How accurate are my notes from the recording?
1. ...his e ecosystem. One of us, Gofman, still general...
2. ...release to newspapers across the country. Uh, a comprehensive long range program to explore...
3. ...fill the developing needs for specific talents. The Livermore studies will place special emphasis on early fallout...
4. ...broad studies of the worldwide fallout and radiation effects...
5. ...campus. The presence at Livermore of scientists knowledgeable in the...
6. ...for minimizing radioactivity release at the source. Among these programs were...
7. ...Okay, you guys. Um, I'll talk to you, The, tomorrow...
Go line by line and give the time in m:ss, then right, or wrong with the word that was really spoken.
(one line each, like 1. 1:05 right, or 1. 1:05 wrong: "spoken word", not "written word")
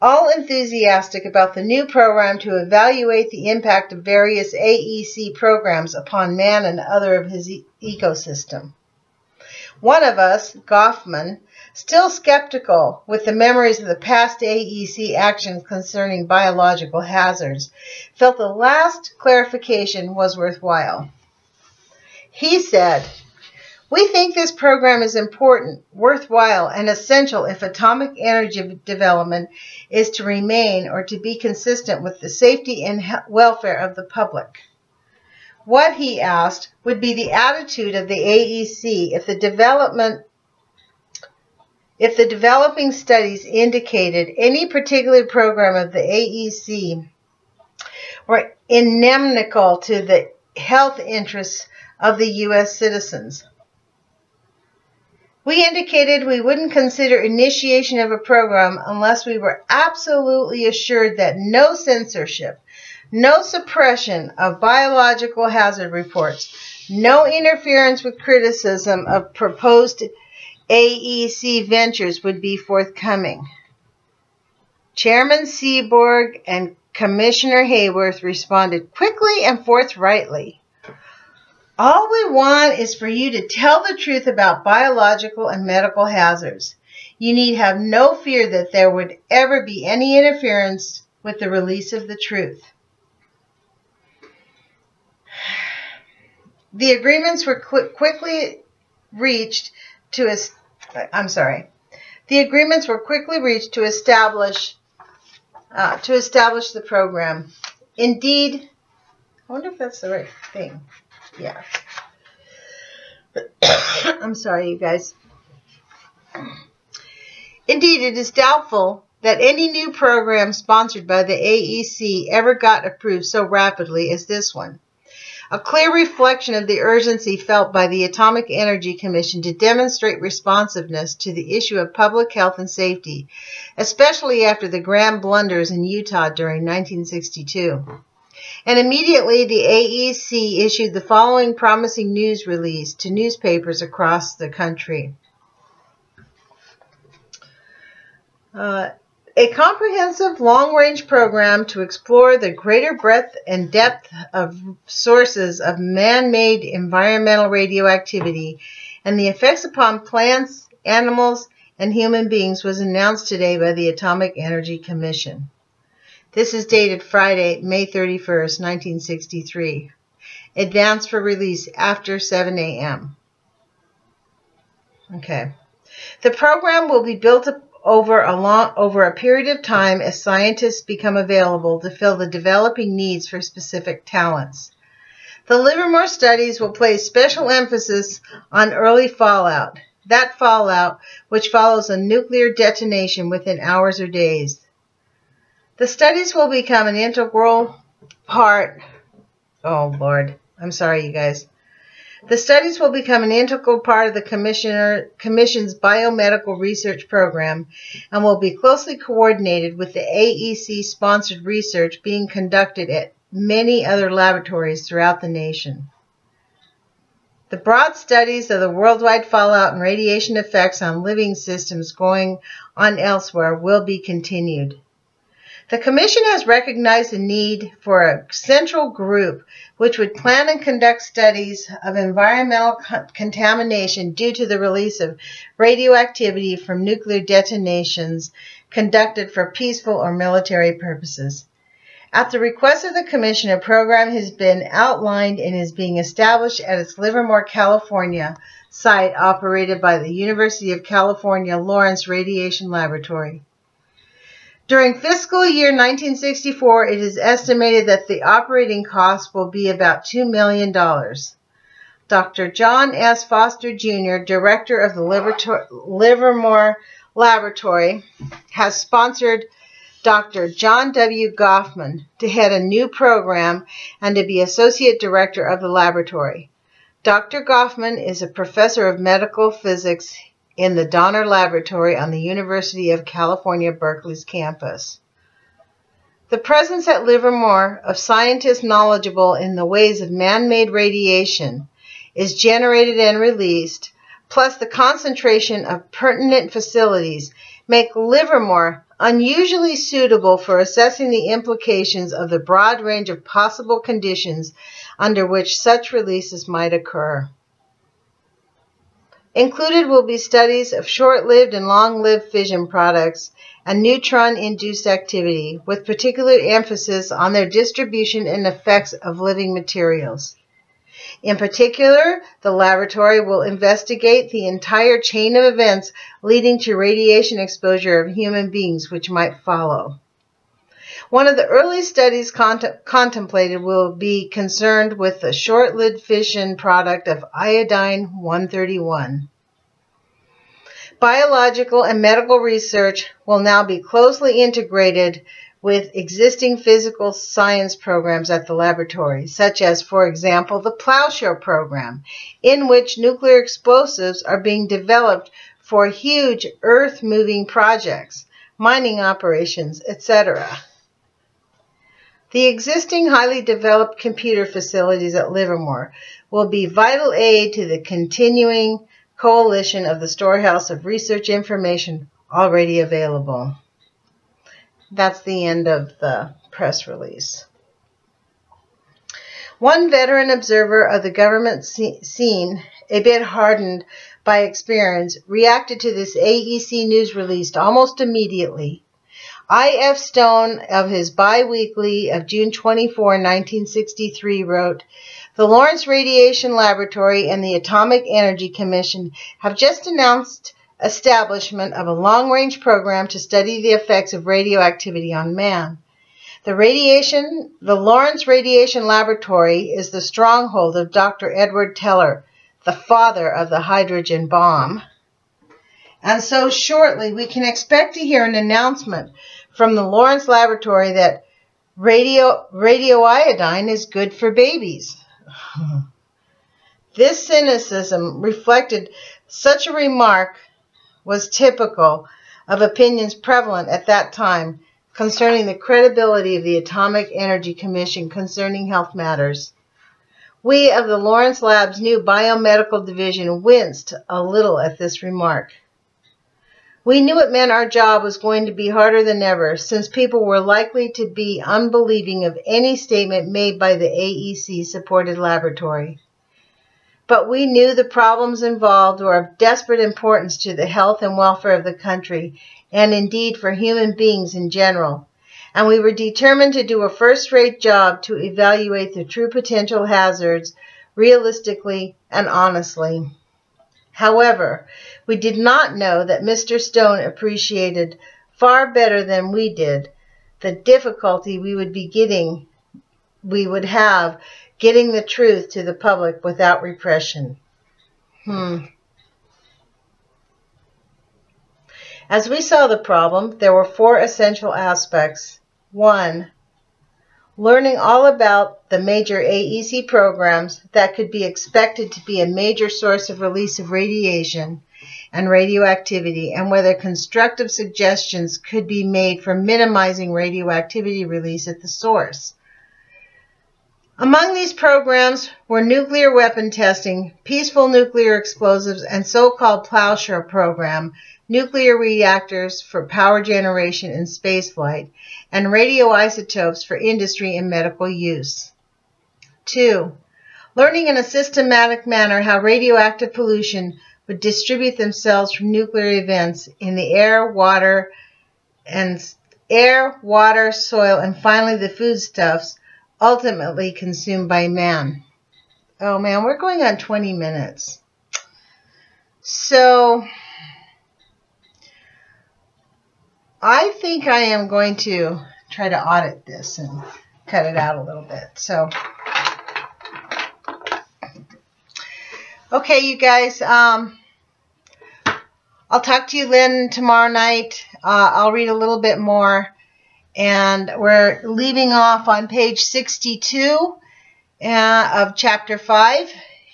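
1. 0:07 wrong: "skeptical", not "general"
2. 2:22 right
3. 3:01 right
4. 3:37 right
5. 4:44 right
6. 8:29 right
7. 9:22 wrong: "Lynn", not "The".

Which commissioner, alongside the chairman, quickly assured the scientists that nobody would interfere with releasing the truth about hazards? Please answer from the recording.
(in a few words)
Haworth.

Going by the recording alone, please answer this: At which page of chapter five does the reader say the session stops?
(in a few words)
62.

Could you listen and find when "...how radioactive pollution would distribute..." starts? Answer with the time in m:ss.
8:52.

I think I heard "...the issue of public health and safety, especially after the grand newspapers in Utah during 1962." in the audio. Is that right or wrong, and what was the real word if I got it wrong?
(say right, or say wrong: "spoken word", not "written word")
wrong: "blunders", not "newspapers".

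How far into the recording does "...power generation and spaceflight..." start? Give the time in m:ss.
8:42.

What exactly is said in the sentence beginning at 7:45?
And we were determined to do a first rate job to evaluate the true potential hazards realistically and honestly.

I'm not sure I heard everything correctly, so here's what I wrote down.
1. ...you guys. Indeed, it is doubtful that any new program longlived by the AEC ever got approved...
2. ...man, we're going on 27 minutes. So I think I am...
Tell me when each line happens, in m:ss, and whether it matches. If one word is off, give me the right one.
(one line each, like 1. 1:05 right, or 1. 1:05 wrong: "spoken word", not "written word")
1. 1:54 wrong: "sponsored", not "longlived"
2. 9:05 wrong: "20", not "27".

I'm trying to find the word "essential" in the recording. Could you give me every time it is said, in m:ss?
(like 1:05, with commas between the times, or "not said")
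0:26, 8:13.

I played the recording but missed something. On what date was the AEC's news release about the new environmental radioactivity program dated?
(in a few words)
Friday, May 31, 1963.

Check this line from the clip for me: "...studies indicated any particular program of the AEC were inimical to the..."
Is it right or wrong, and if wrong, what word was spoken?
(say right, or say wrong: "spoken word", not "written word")
right.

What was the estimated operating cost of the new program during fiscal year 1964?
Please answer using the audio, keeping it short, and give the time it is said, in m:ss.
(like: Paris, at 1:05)
$2 million, at 4:20.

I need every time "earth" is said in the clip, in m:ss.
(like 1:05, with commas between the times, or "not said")
5:56.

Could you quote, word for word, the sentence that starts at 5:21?
In particular, the laboratory will investigate the entire chain of events leading to radiation exposure of human beings which might follow.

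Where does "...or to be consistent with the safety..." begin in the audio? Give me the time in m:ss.
0:30.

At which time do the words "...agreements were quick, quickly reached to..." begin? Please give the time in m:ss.
1:36.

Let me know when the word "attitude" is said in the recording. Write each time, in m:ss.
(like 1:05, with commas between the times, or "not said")
0:37.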